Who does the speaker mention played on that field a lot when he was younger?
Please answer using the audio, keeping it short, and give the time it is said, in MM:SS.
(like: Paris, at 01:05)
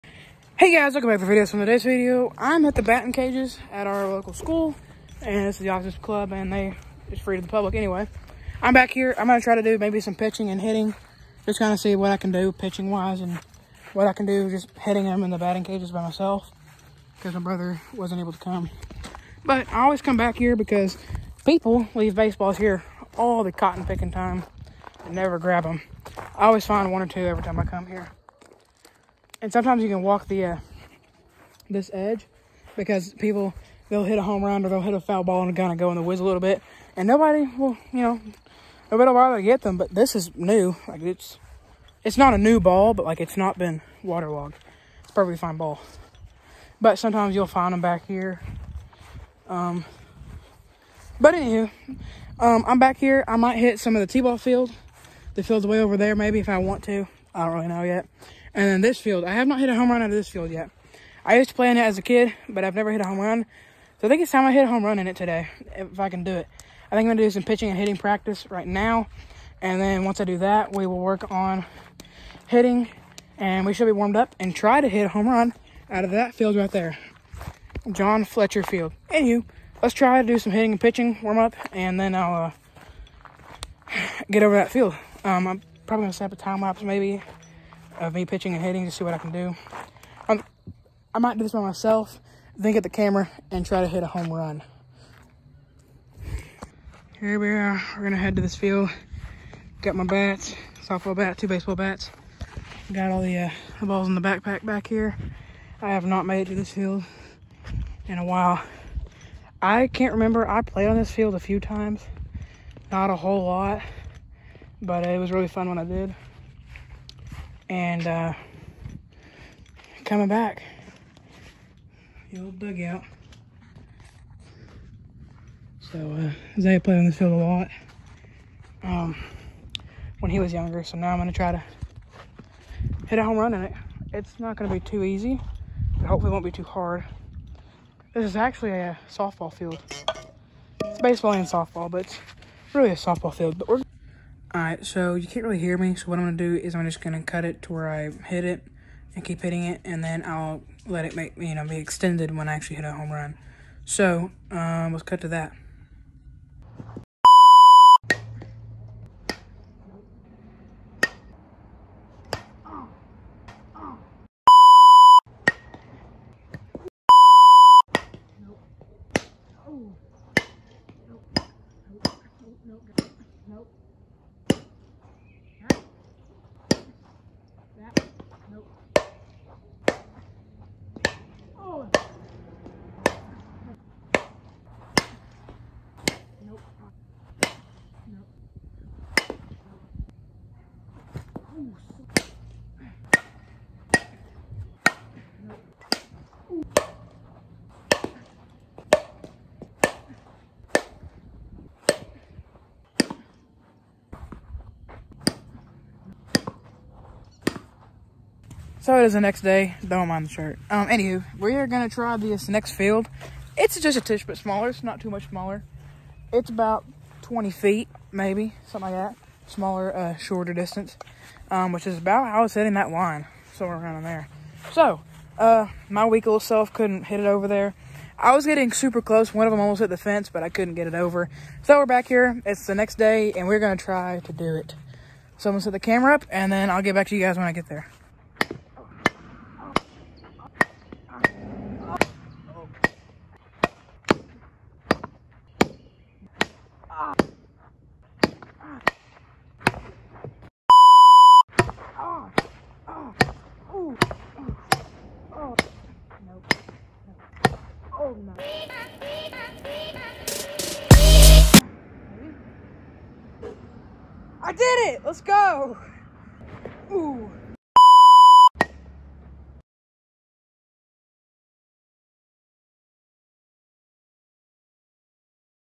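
Isaiah, at 02:06.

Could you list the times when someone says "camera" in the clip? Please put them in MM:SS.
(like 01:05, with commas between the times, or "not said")
01:32, 03:55.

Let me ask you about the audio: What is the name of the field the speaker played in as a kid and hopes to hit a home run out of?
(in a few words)
John Fletcher Field.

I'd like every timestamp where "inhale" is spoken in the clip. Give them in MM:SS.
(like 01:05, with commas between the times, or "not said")
not said.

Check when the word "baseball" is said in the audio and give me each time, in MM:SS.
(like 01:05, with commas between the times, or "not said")
00:22, 01:41, 02:21.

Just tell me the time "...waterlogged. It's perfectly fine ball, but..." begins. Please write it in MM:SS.
00:44.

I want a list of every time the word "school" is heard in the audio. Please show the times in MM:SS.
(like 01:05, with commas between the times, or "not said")
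00:04.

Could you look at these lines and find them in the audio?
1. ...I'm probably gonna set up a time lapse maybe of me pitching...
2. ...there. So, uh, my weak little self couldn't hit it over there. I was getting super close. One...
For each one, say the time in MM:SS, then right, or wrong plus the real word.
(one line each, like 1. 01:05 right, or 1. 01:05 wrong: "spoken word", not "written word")
1. 01:25 right
2. 03:44 right.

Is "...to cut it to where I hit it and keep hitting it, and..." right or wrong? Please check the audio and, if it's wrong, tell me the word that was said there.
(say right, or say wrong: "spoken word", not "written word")
right.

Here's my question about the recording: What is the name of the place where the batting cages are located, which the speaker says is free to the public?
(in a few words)
The officers club.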